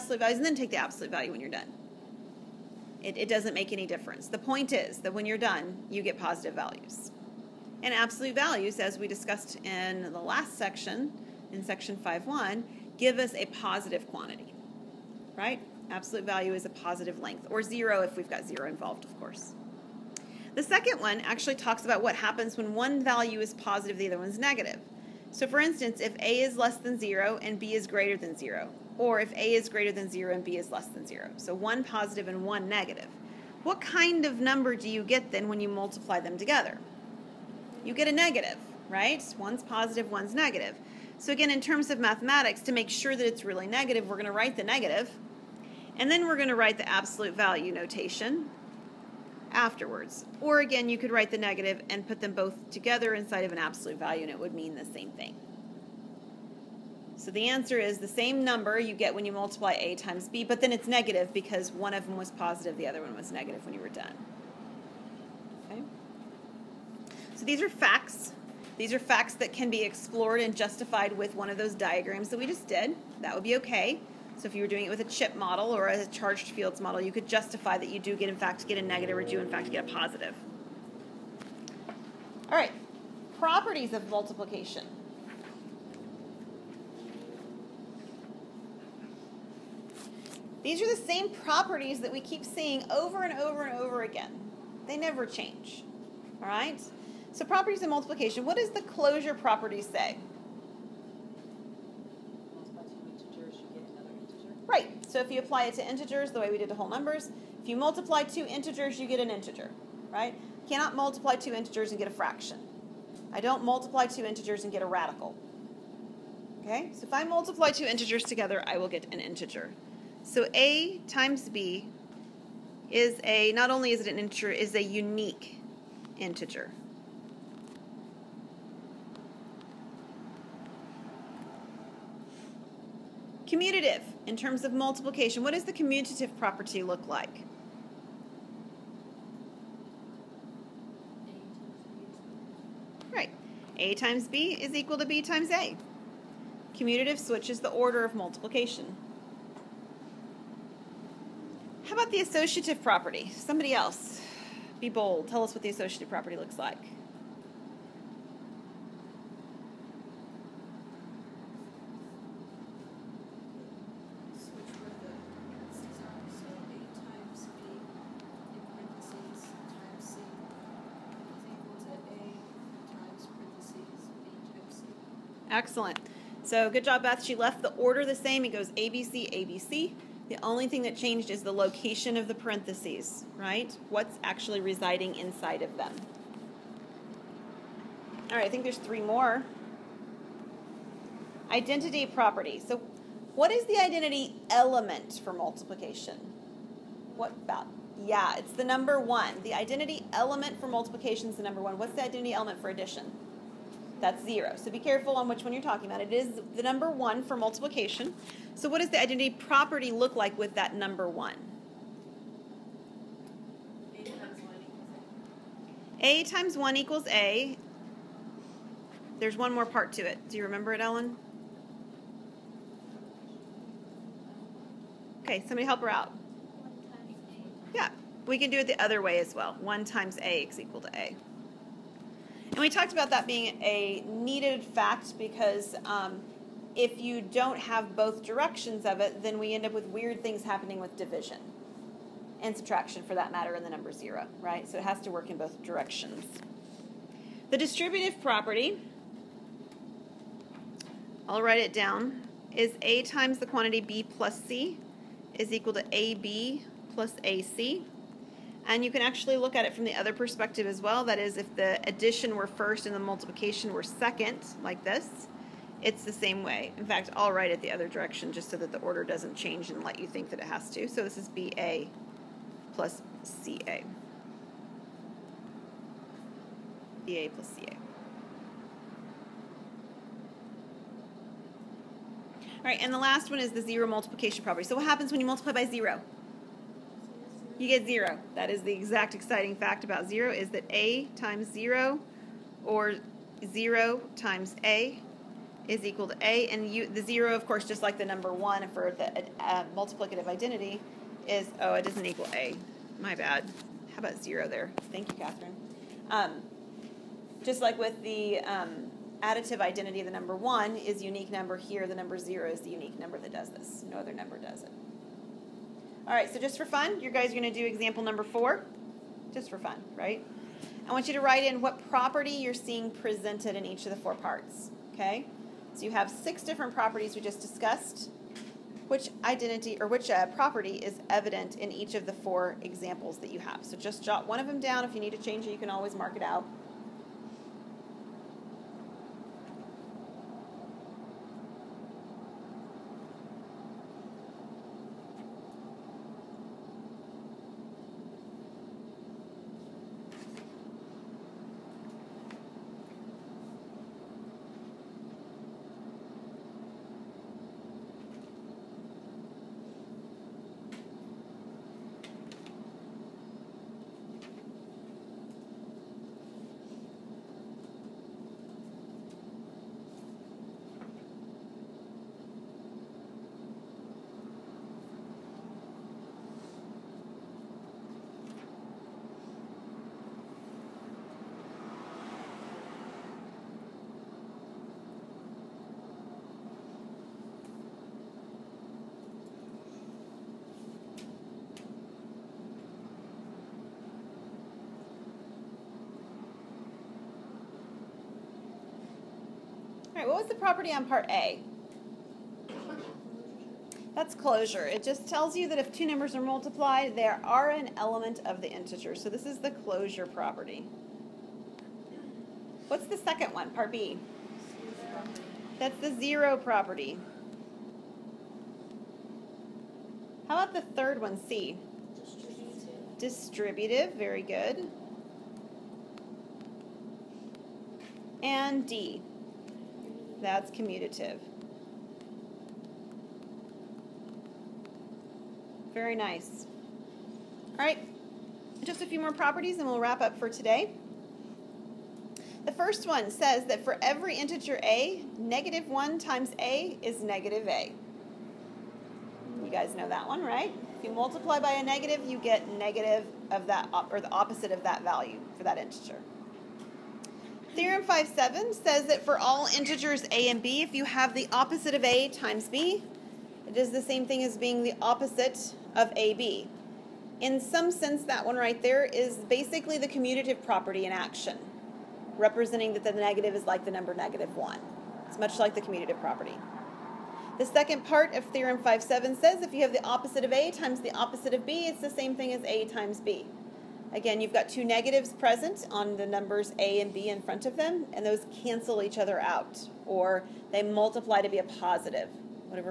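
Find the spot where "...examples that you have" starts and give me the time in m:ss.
5:32.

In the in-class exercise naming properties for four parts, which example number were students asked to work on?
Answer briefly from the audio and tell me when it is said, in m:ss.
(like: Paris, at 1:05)
4, at 5:17.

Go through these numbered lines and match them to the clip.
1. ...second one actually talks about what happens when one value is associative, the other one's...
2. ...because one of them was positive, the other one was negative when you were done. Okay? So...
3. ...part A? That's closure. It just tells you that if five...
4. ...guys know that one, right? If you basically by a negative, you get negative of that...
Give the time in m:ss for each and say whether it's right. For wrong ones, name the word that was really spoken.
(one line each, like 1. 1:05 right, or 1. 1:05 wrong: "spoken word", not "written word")
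1. 0:20 wrong: "positive", not "associative"
2. 1:01 right
3. 6:40 wrong: "two", not "five"
4. 7:29 wrong: "multiply", not "basically".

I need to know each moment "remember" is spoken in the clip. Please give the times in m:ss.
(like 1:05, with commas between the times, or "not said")
3:40.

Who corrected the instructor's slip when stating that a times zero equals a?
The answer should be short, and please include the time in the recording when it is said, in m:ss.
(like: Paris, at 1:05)
Catherine, at 5:05.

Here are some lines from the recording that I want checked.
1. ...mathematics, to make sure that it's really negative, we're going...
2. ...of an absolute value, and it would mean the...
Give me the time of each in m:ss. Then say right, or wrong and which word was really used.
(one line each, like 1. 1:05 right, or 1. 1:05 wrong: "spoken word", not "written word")
1. 0:41 right
2. 0:53 right.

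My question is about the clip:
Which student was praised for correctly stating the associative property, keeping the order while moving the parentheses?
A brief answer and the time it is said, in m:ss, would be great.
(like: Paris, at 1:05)
Beth, at 2:57.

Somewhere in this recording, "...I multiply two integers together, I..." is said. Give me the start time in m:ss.
1:57.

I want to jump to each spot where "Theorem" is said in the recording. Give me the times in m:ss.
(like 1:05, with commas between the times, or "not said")
7:37, 7:58.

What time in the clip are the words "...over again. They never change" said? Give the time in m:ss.
1:33.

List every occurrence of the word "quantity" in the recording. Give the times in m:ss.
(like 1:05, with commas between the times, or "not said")
0:14, 4:13.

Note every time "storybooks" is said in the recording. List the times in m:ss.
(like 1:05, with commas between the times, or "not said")
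not said.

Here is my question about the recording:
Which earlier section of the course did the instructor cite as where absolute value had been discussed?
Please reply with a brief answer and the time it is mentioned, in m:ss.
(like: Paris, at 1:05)
5.1, at 0:11.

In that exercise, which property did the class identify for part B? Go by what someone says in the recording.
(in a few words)
Zero property.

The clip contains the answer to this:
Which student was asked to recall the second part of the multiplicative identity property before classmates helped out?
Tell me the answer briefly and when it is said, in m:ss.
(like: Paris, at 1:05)
Ellen, at 3:40.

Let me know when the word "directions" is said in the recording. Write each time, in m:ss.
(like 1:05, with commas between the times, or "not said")
3:58, 4:05, 4:27.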